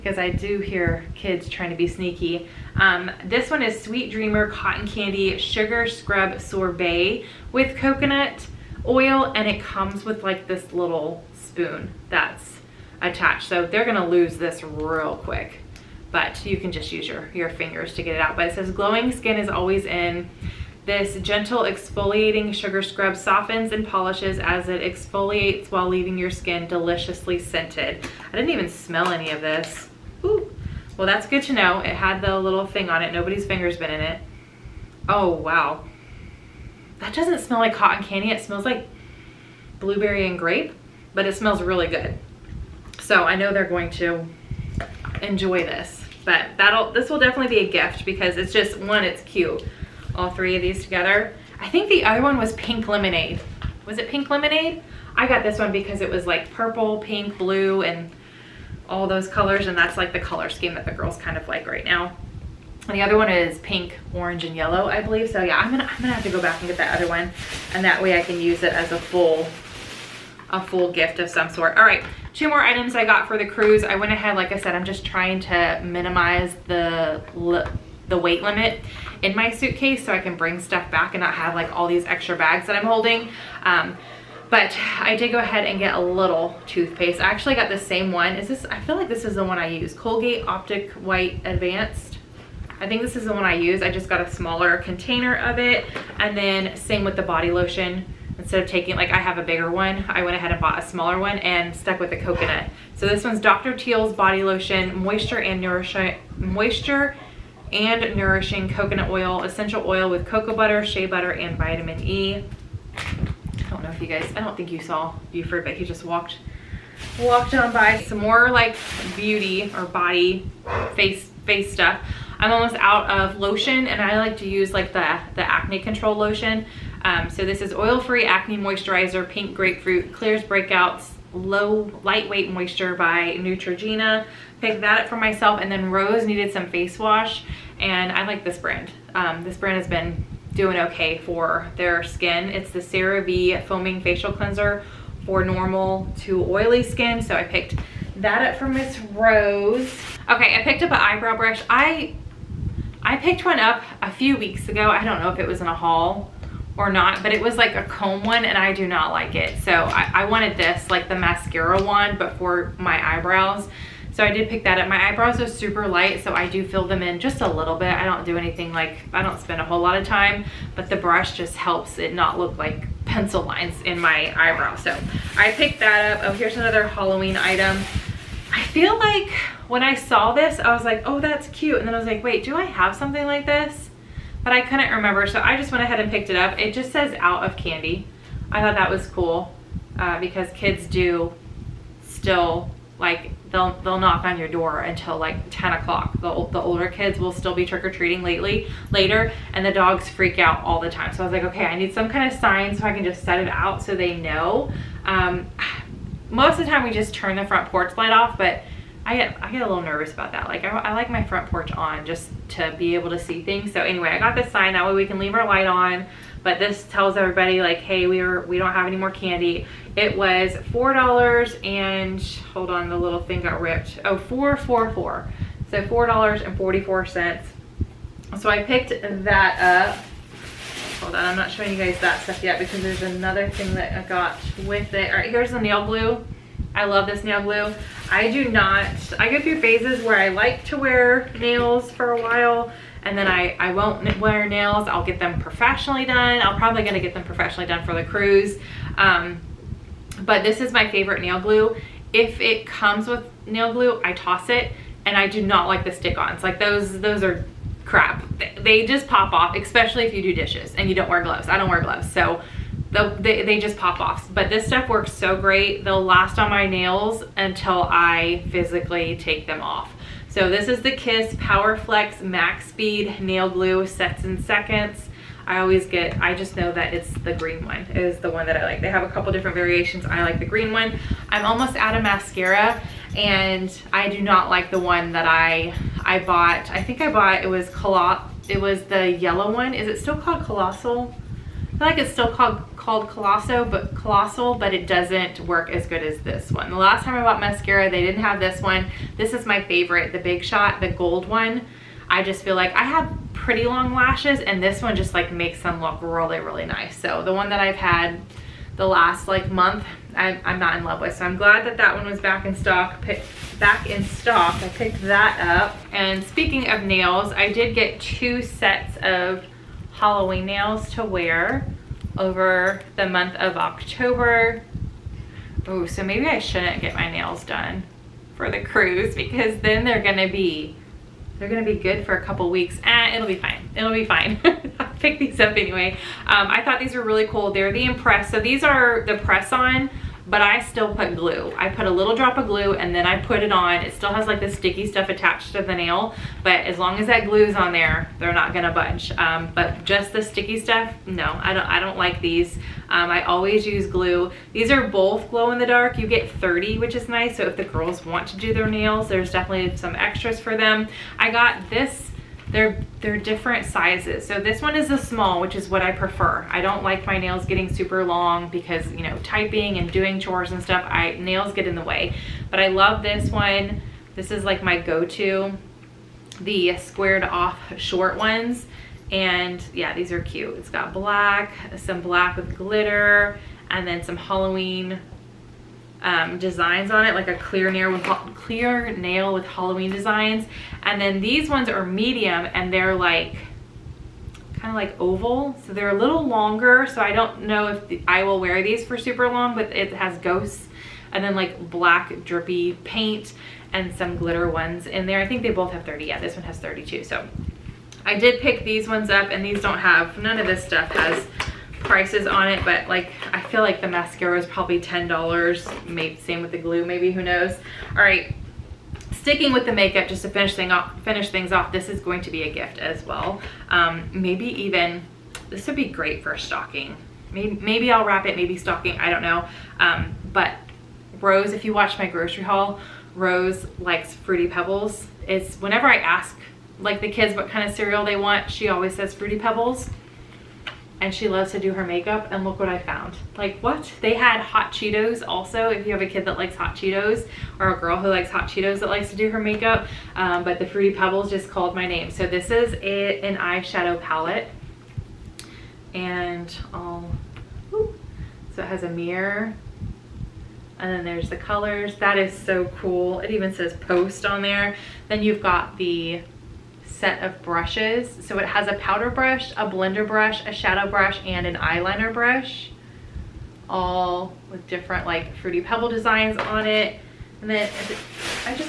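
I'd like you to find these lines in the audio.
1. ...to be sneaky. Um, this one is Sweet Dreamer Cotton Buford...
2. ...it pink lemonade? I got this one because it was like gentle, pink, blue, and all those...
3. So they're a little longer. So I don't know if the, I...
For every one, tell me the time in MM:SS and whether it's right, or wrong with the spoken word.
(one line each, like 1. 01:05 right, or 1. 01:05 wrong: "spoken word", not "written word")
1. 00:01 wrong: "Candy", not "Buford"
2. 00:53 wrong: "purple", not "gentle"
3. 06:35 right.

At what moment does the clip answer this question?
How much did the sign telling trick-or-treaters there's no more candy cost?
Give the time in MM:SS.
03:45.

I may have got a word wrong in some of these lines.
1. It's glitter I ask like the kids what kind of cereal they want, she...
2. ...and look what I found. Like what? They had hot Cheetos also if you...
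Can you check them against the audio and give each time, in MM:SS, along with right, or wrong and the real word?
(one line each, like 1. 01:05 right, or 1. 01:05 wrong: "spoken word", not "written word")
1. 07:15 wrong: "whenever", not "glitter"
2. 07:22 right.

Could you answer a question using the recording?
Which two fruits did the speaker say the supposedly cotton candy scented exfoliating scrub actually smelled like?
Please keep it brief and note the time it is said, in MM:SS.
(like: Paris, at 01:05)
blueberry and grape, at 00:39.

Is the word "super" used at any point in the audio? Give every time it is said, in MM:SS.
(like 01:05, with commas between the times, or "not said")
02:45, 06:07, 06:38.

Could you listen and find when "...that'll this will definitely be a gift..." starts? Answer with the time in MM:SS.
00:46.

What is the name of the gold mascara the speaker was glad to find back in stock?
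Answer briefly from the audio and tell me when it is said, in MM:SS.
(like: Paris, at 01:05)
Big Shot, at 05:00.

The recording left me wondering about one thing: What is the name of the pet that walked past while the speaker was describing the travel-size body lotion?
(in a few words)
Buford.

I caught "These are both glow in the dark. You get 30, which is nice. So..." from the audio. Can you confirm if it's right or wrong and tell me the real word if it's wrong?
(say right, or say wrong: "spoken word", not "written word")
right.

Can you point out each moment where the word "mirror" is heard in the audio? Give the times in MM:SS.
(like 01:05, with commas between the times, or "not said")
07:38.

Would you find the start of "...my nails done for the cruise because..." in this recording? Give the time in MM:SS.
05:26.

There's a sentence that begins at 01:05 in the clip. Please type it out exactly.
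So yeah, I'm gonna, I'm gonna have to go back and get that other one.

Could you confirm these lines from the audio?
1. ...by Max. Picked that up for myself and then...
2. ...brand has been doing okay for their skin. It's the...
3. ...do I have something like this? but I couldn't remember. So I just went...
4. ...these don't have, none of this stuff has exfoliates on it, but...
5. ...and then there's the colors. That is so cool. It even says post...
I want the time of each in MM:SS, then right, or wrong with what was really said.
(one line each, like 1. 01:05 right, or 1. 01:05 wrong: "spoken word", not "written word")
1. 02:12 wrong: "Neutrogena", not "Max"
2. 02:19 right
3. 03:02 right
4. 06:49 wrong: "prices", not "exfoliates"
5. 07:40 right.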